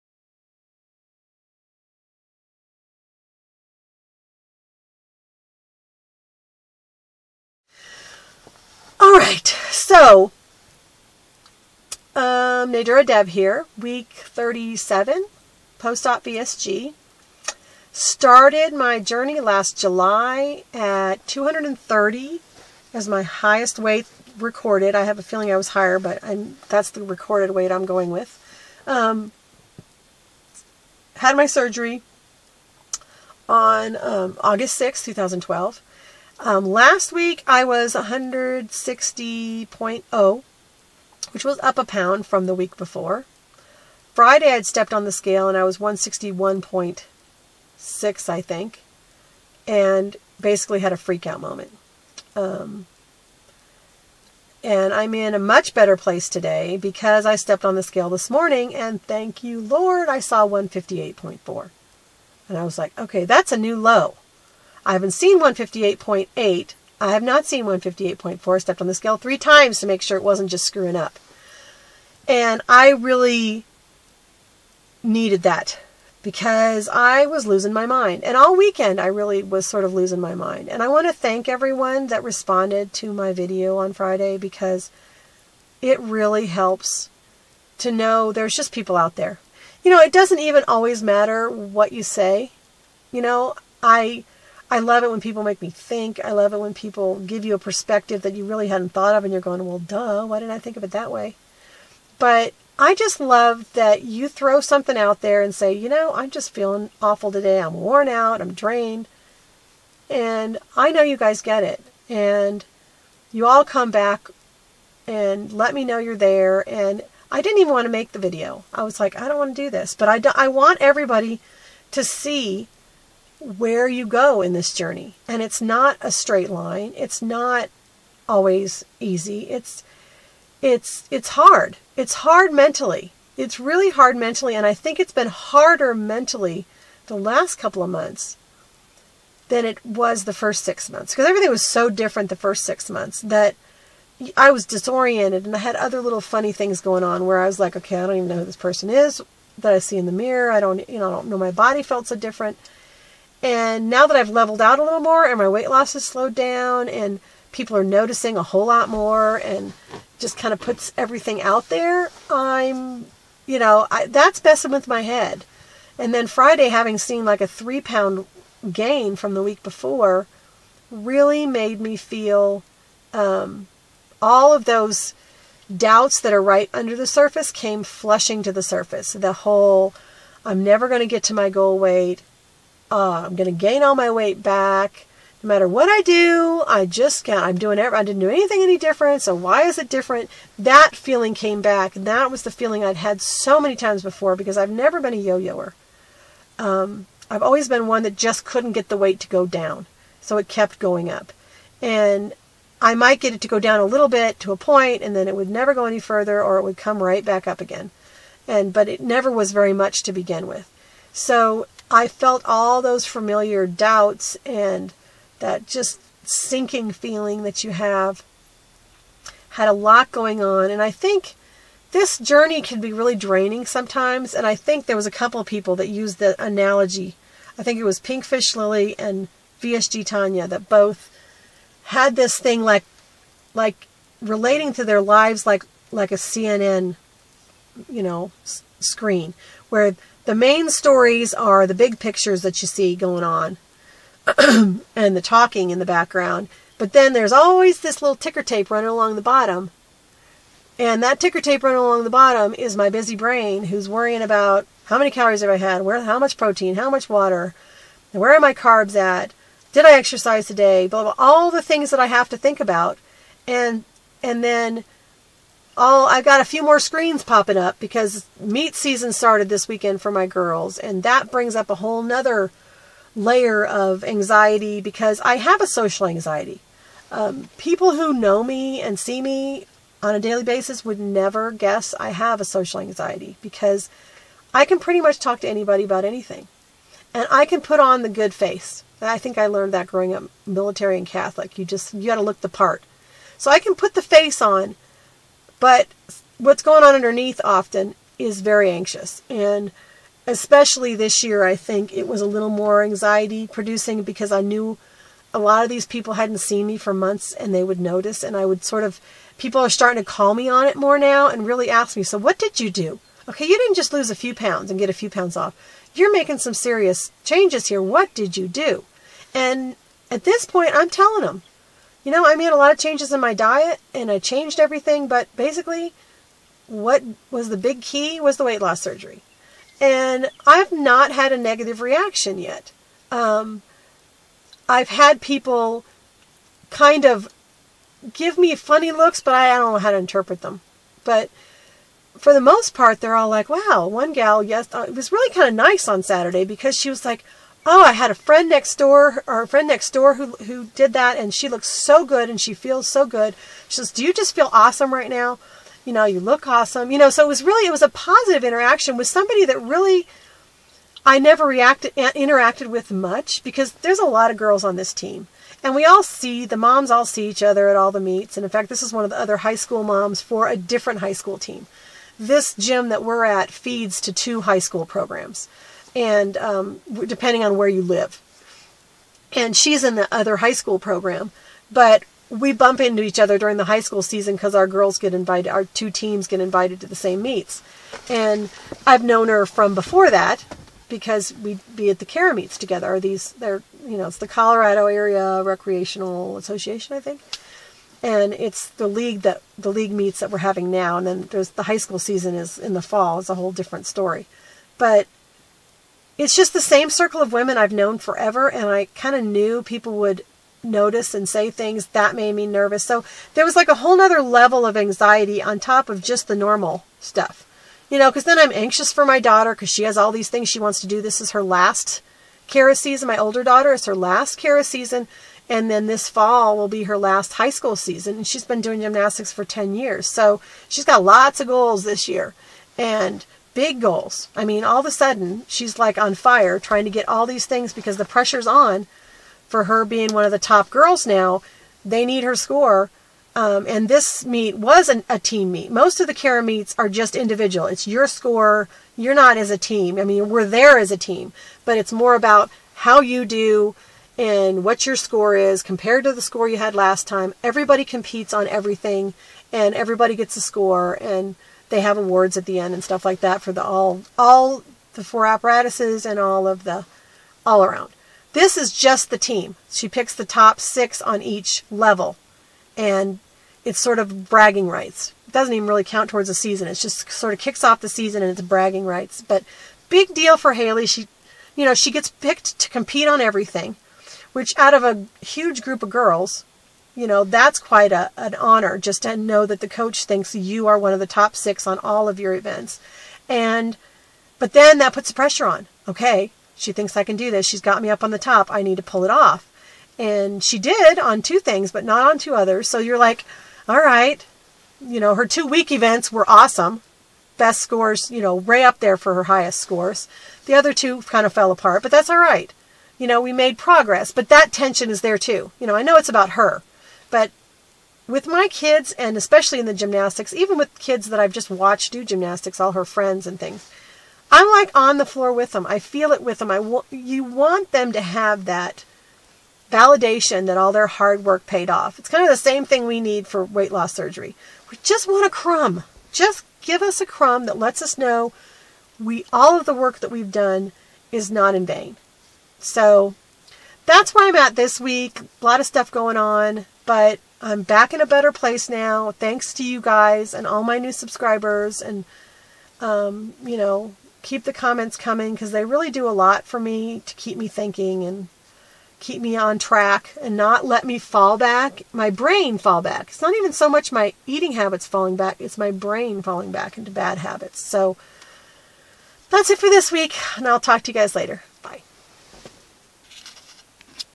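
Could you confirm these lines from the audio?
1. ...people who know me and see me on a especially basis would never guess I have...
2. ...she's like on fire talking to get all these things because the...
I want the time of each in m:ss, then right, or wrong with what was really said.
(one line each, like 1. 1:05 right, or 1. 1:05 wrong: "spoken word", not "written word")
1. 4:37 wrong: "daily", not "especially"
2. 7:15 wrong: "trying", not "talking".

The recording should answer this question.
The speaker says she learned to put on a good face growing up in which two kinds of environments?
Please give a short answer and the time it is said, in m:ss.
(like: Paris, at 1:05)
military and Catholic, at 4:50.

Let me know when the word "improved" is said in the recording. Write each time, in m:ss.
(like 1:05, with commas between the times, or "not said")
not said.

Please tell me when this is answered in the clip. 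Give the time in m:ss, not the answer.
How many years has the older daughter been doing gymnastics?
7:09.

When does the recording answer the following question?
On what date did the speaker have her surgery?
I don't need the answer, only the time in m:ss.
0:34.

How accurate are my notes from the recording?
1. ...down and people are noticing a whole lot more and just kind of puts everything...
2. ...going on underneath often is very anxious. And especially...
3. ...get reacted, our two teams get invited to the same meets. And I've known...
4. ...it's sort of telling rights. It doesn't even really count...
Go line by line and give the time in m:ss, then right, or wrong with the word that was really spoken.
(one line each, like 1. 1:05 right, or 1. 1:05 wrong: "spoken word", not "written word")
1. 2:36 right
2. 4:56 right
3. 6:24 wrong: "invited", not "reacted"
4. 7:53 wrong: "bragging", not "telling".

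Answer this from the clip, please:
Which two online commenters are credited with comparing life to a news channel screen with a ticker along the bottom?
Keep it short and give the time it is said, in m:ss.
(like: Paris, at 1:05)
Pinkfish Lily and VSG Tanya, at 3:47.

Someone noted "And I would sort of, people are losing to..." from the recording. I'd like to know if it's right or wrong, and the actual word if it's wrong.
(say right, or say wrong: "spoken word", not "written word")
wrong: "starting", not "losing".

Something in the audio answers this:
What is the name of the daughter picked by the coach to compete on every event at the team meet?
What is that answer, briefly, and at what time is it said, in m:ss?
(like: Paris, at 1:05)
Haley, at 8:00.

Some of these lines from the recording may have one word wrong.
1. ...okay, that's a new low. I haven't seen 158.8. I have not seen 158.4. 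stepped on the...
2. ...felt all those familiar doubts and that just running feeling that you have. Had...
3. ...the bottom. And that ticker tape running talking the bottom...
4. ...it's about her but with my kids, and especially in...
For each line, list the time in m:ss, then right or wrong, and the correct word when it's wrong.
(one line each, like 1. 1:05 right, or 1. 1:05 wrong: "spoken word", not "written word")
1. 1:02 right
2. 3:32 wrong: "sinking", not "running"
3. 4:09 wrong: "along", not "talking"
4. 8:35 right.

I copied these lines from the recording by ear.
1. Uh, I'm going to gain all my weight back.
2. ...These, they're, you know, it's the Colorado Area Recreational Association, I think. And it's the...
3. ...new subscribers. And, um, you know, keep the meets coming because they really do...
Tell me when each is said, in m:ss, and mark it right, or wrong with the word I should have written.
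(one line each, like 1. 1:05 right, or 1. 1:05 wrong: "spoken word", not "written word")
1. 3:02 right
2. 6:32 right
3. 9:10 wrong: "comments", not "meets".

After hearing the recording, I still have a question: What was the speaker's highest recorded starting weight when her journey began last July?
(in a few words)
230.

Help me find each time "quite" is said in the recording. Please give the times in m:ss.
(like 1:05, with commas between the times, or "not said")
8:07.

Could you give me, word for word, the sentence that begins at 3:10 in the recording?
That feeling came back, and that was the feeling I'd had so many times before because I've never been a yo-yoer.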